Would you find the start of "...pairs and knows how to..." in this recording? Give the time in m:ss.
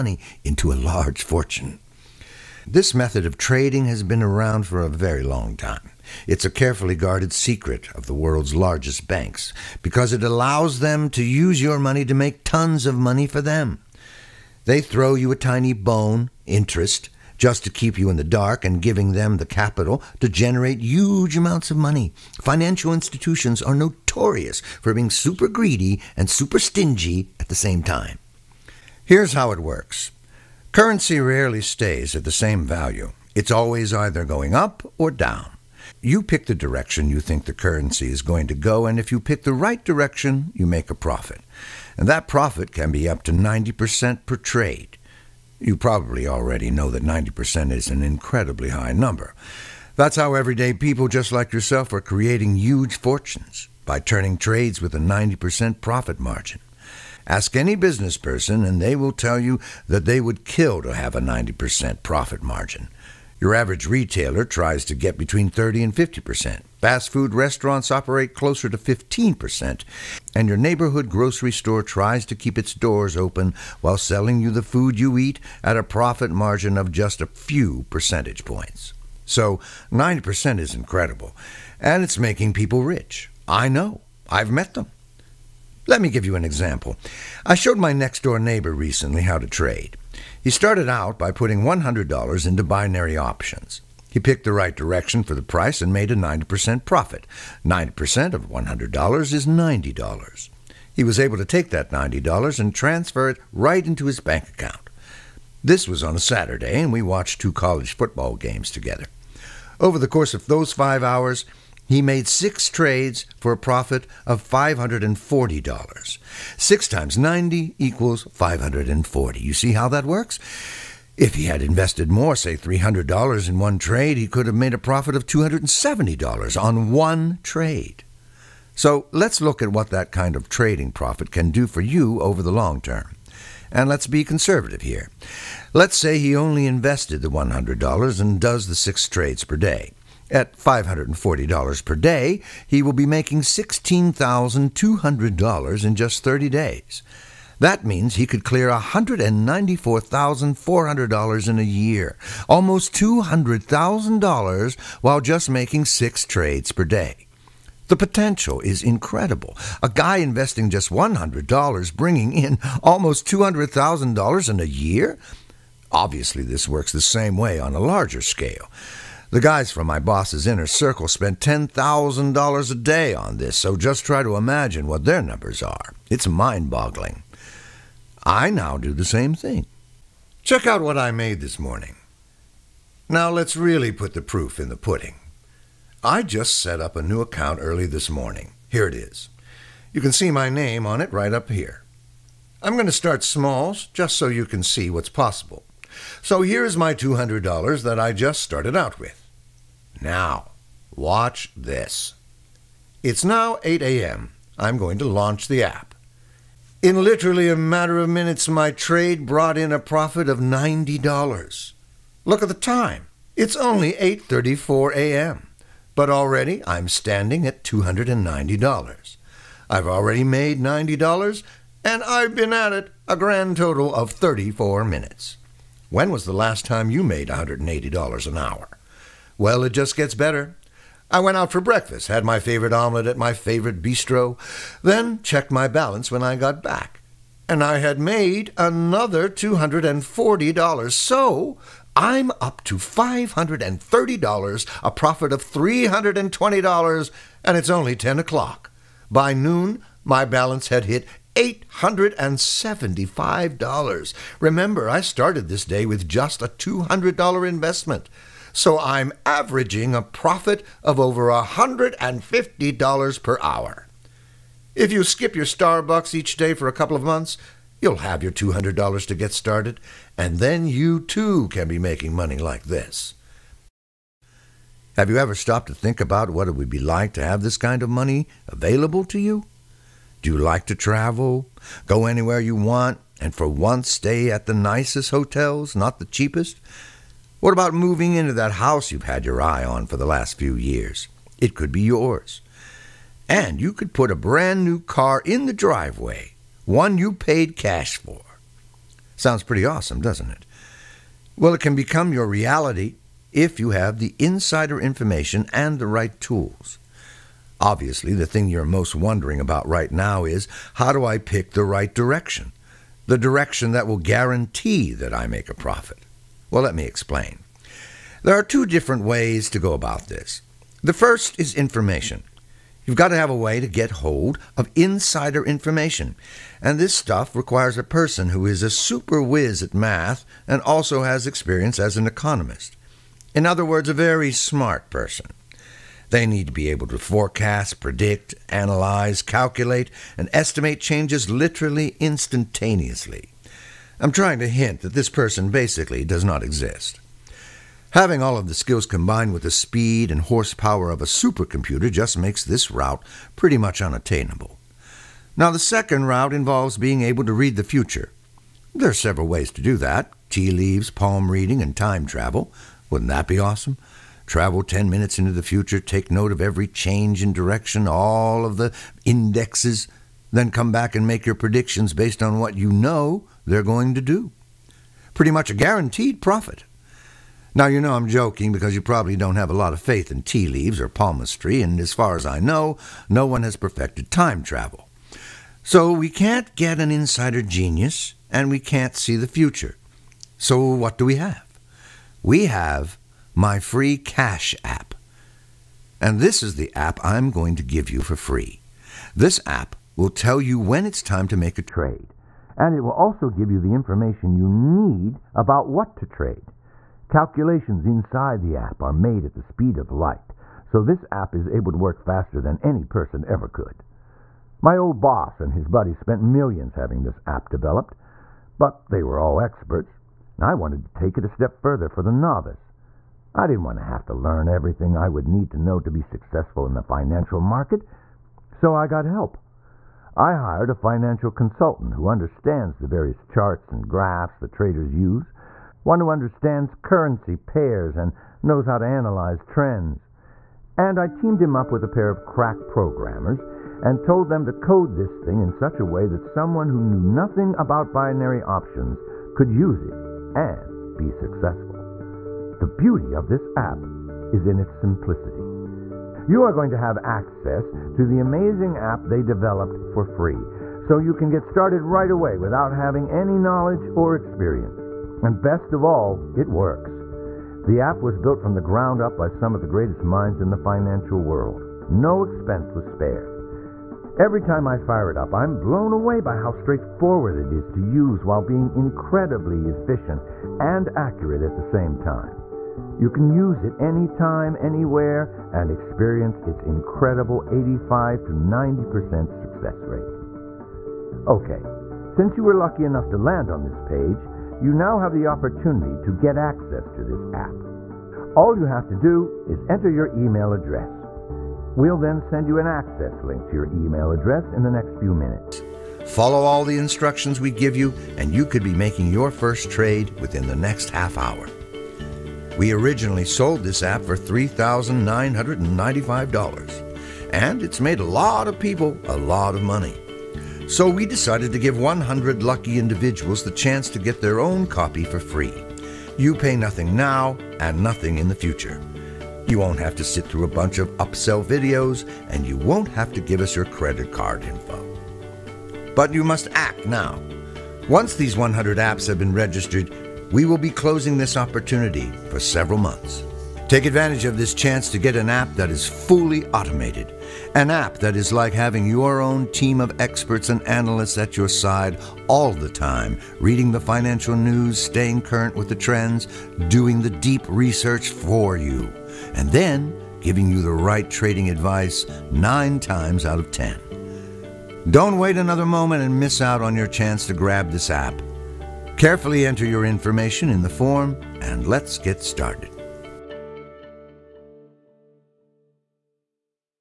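7:17.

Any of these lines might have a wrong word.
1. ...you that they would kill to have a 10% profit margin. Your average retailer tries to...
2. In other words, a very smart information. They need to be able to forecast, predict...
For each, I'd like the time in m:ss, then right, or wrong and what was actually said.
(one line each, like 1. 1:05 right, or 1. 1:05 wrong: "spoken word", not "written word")
1. 0:59 wrong: "90", not "10"
2. 5:33 wrong: "person", not "information".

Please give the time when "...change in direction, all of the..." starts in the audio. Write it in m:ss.
6:06.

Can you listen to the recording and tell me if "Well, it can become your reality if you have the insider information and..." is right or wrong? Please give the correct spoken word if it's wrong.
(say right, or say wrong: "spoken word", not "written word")
right.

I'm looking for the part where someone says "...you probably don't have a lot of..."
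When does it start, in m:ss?
6:18.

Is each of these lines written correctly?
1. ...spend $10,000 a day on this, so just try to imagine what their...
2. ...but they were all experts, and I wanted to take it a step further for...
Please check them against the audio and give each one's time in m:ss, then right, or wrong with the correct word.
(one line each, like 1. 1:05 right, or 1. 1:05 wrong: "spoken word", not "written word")
1. 2:51 right
2. 6:58 right.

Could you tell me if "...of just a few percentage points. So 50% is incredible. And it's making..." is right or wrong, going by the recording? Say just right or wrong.
wrong.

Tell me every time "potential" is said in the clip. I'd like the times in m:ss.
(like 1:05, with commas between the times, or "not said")
2:37.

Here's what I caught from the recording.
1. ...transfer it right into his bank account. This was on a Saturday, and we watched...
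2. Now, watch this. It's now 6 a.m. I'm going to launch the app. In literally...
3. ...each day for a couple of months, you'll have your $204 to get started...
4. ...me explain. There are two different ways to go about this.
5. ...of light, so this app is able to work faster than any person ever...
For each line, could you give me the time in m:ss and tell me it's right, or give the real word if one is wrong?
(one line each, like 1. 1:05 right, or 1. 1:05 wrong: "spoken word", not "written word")
1. 1:42 right
2. 3:19 wrong: "8", not "6"
3. 4:26 wrong: "200", not "204"
4. 5:16 right
5. 6:49 right.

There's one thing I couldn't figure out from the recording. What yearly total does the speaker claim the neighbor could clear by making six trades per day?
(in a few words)
$194,400.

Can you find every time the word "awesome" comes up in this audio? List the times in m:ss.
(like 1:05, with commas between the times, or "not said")
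4:59, 6:03.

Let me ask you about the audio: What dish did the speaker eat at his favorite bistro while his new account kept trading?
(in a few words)
omelet.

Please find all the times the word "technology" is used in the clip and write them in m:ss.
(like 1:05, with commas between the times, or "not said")
not said.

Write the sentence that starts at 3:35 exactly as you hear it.
But already I'm standing at $290.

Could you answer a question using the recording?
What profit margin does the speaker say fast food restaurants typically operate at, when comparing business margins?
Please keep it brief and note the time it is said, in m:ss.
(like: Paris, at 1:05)
15%, at 1:08.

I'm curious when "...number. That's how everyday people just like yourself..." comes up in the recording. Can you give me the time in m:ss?
0:48.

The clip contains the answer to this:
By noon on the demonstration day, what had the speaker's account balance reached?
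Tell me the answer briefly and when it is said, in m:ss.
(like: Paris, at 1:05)
$875, at 4:11.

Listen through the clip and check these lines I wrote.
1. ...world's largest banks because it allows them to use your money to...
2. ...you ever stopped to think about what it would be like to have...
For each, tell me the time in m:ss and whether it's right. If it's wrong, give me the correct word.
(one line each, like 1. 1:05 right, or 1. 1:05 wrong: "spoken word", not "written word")
1. 0:08 right
2. 4:35 right.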